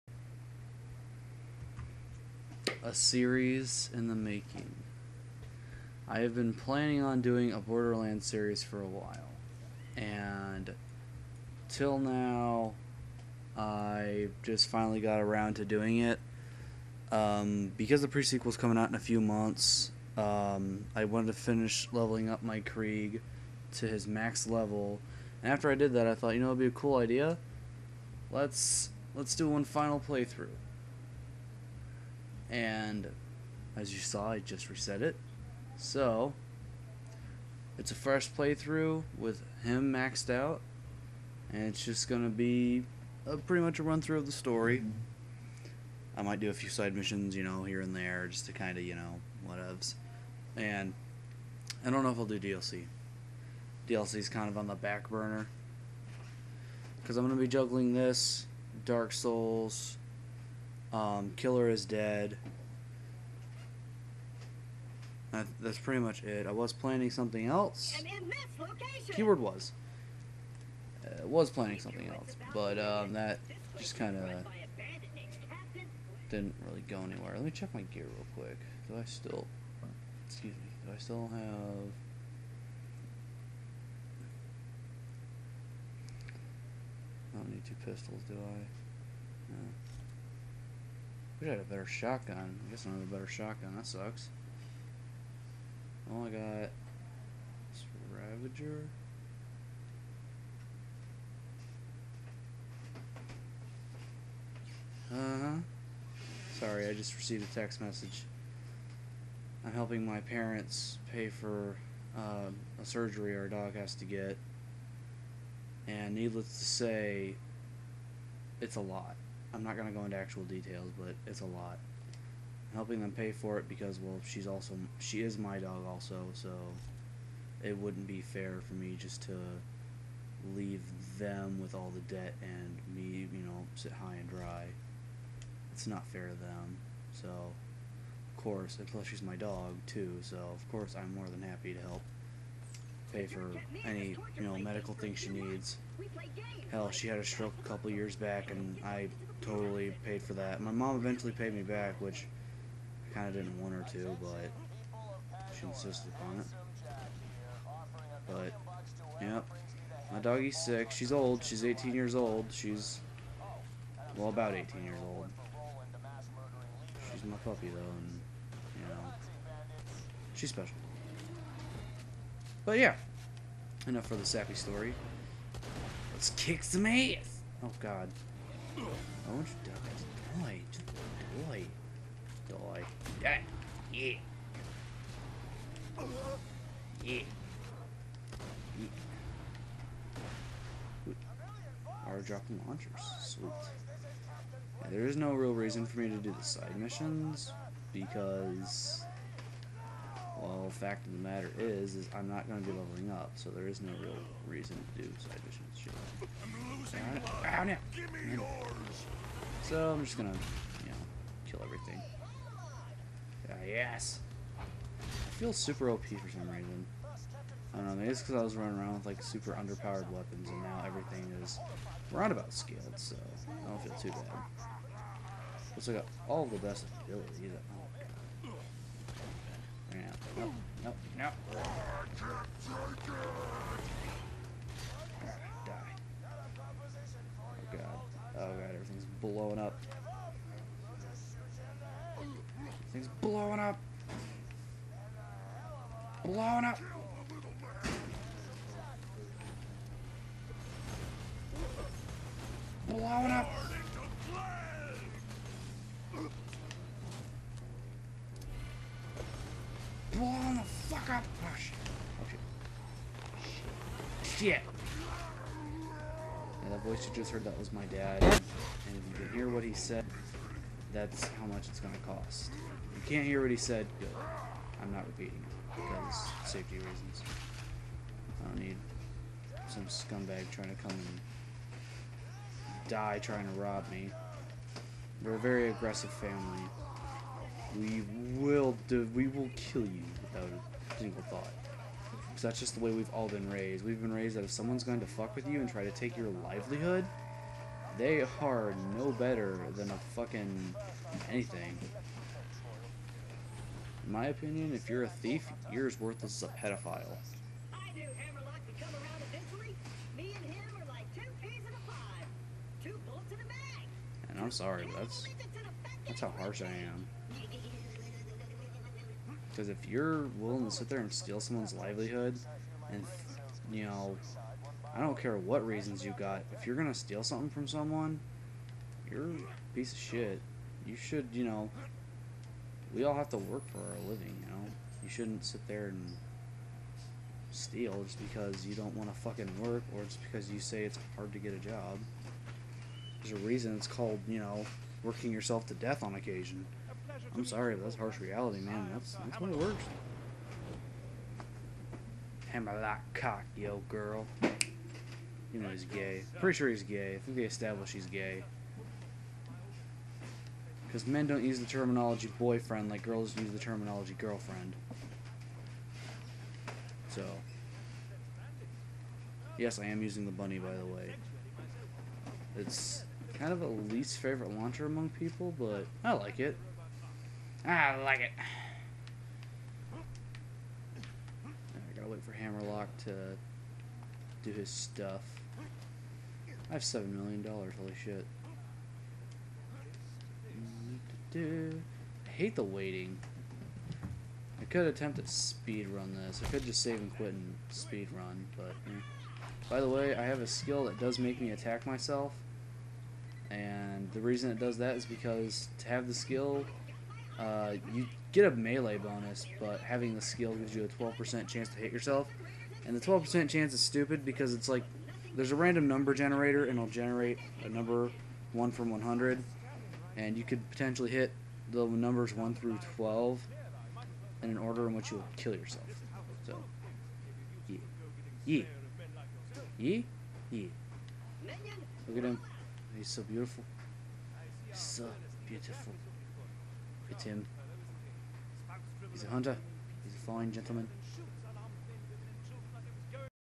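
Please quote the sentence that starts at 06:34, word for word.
I could attempt to speed run this.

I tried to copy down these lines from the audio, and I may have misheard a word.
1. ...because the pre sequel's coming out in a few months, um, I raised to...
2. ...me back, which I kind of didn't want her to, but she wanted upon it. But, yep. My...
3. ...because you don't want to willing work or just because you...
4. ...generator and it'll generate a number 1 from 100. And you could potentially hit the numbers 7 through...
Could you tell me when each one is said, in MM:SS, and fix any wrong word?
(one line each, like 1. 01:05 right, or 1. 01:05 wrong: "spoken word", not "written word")
1. 00:17 wrong: "wanted", not "raised"
2. 02:31 wrong: "insisted", not "wanted"
3. 05:38 wrong: "fucking", not "willing"
4. 06:56 wrong: "1", not "7".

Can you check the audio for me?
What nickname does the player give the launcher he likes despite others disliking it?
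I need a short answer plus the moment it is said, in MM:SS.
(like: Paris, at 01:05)
the bunny, at 06:10.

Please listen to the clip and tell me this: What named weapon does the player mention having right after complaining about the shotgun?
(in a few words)
Ravager.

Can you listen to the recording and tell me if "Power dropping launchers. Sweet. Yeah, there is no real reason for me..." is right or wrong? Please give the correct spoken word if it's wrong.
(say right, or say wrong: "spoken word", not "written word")
right.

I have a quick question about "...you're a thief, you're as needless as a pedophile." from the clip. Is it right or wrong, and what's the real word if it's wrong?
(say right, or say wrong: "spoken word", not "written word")
wrong: "worthless", not "needless".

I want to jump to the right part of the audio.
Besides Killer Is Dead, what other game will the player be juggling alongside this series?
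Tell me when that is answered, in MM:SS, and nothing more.
00:58.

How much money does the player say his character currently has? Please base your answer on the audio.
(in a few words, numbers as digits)
7 million dollars.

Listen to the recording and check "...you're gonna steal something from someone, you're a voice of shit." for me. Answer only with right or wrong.
wrong.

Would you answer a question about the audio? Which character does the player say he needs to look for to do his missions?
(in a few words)
Hammerlock.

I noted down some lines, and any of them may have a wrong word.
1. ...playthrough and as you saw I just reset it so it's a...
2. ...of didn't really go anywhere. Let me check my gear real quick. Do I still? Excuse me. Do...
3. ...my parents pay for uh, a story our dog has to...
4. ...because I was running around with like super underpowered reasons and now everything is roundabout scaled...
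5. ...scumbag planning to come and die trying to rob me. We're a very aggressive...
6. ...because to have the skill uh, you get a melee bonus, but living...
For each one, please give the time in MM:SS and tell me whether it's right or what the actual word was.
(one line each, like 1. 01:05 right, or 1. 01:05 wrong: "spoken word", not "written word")
1. 00:30 right
2. 01:14 right
3. 01:50 wrong: "surgery", not "story"
4. 03:38 wrong: "weapons", not "reasons"
5. 04:39 wrong: "trying", not "planning"
6. 06:45 wrong: "having", not "living".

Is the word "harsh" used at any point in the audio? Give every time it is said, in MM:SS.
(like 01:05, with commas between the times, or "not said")
05:16, 05:47.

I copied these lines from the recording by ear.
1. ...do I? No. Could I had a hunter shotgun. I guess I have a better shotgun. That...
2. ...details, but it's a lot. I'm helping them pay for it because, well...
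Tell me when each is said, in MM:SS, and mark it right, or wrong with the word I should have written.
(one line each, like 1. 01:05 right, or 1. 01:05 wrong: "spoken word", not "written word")
1. 01:28 wrong: "better", not "hunter"
2. 02:00 right.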